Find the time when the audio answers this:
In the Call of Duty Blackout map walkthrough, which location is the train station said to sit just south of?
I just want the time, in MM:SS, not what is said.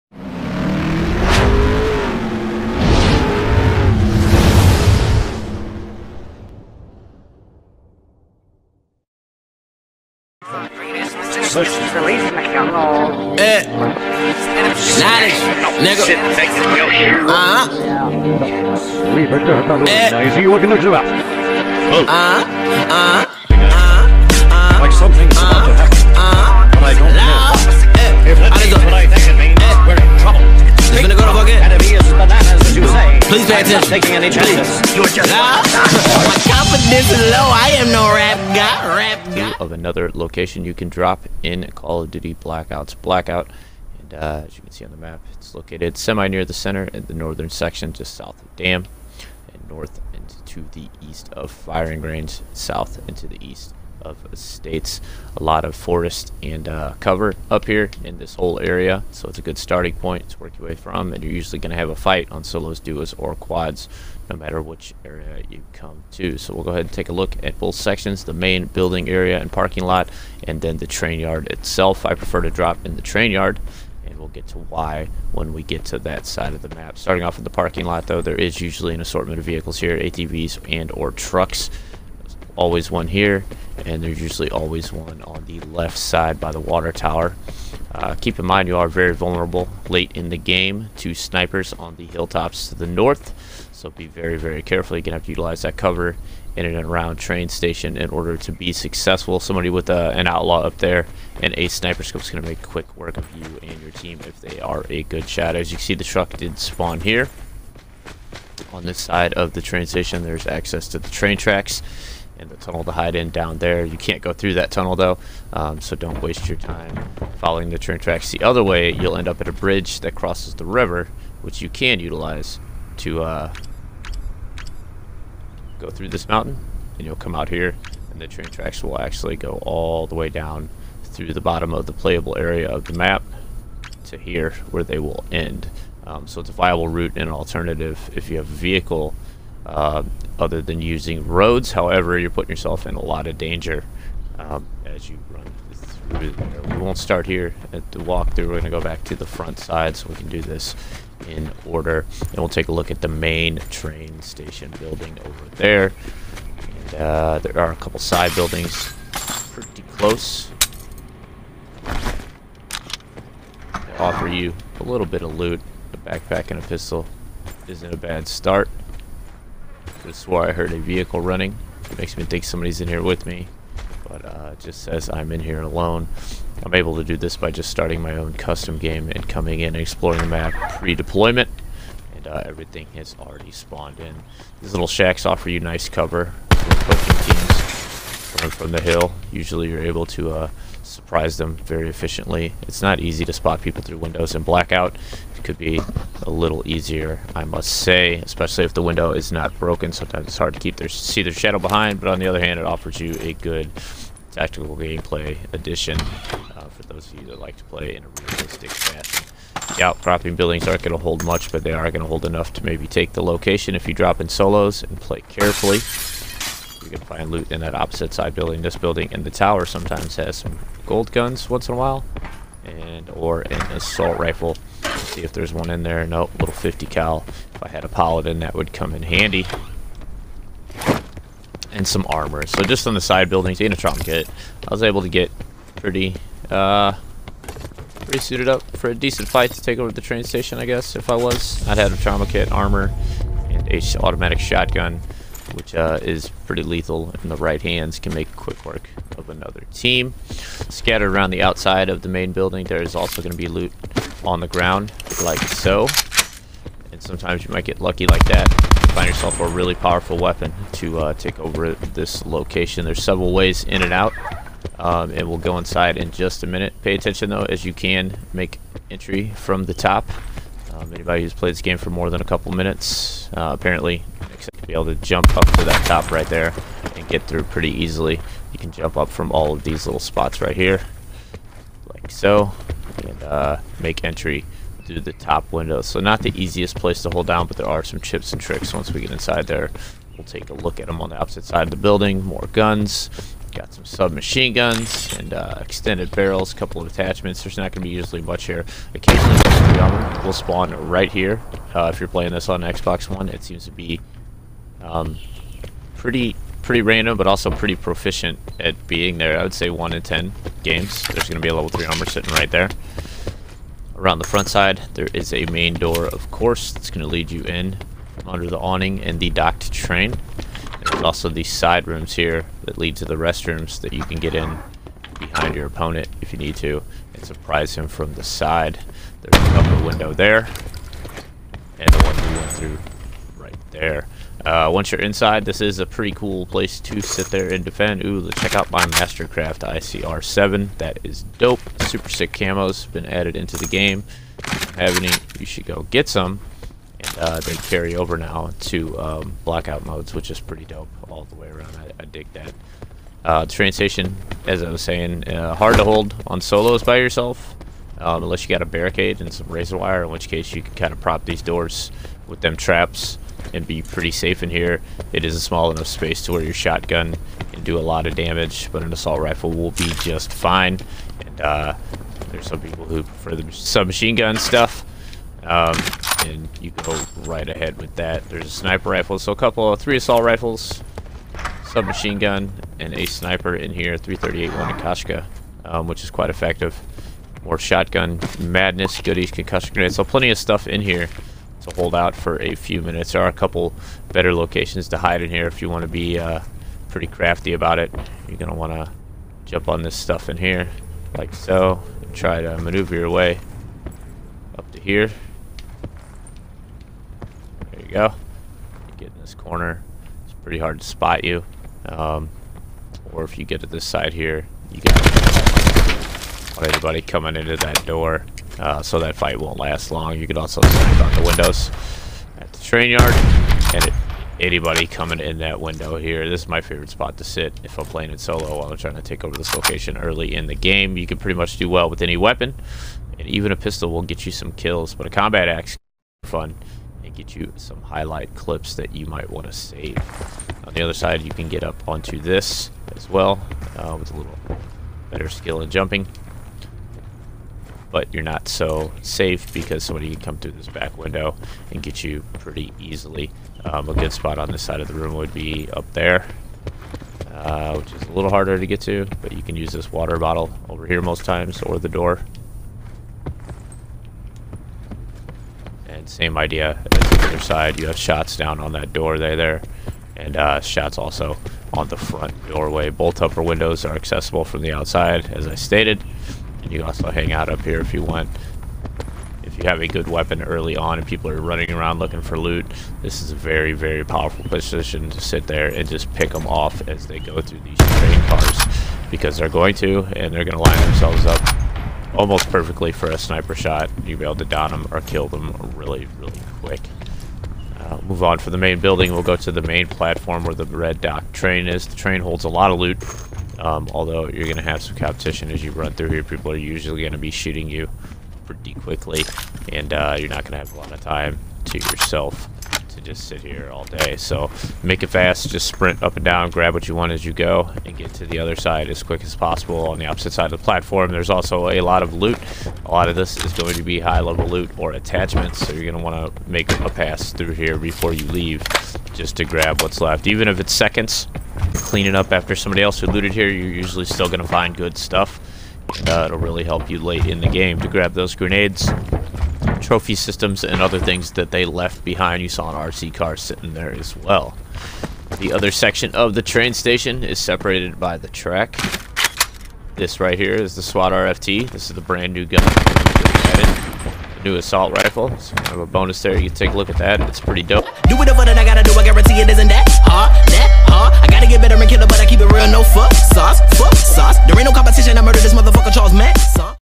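00:48.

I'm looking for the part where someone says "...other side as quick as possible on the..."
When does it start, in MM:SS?
08:38.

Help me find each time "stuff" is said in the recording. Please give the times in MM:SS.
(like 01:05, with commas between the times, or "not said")
06:14, 06:30, 06:39, 08:54.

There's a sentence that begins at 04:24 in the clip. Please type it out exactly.
Um, and we'll go inside in just a minute.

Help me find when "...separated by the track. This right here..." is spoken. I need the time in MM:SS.
09:07.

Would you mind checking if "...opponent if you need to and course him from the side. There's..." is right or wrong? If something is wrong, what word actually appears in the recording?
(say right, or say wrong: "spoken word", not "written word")
wrong: "surprise", not "course".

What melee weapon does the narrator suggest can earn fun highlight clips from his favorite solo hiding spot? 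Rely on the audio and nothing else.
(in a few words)
Combat axe.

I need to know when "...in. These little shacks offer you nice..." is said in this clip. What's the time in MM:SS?
03:04.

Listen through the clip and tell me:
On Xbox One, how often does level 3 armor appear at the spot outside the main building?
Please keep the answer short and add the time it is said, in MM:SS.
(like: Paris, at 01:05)
1 in 10 games, at 05:09.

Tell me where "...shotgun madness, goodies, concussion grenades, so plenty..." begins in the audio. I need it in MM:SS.
06:27.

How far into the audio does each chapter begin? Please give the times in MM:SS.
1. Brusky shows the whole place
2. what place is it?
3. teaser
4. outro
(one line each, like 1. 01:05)
1. 00:40
2. 00:23
3. 00:13
4. 09:19.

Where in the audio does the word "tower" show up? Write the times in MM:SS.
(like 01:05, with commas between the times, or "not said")
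01:26, 03:39.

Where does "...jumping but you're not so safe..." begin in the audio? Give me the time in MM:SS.
07:25.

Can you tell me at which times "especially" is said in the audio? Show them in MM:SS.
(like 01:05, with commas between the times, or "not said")
03:18.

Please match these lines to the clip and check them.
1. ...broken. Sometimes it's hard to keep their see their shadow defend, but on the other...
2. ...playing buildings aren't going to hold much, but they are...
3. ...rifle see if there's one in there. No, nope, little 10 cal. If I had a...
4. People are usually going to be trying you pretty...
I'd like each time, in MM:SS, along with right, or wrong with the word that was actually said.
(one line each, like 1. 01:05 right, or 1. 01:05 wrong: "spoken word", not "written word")
1. 03:19 wrong: "behind", not "defend"
2. 03:29 wrong: "outcropping", not "playing"
3. 03:44 wrong: "50", not "10"
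4. 08:26 wrong: "shooting", not "trying".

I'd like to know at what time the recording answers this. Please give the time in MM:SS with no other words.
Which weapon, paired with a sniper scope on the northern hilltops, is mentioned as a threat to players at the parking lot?
01:40.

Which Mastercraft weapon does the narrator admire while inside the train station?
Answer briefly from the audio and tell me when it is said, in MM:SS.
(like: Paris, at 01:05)
ICR7, at 05:39.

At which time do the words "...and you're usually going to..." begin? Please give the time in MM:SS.
01:01.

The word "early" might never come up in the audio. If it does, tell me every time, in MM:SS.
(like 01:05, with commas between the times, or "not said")
07:09, 08:00.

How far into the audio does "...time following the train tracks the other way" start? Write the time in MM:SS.
01:56.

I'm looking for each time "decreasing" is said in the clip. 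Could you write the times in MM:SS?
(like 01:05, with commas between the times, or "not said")
not said.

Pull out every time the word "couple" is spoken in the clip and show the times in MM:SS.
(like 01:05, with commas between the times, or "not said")
02:37, 04:32, 04:56, 05:29, 06:19, 06:33.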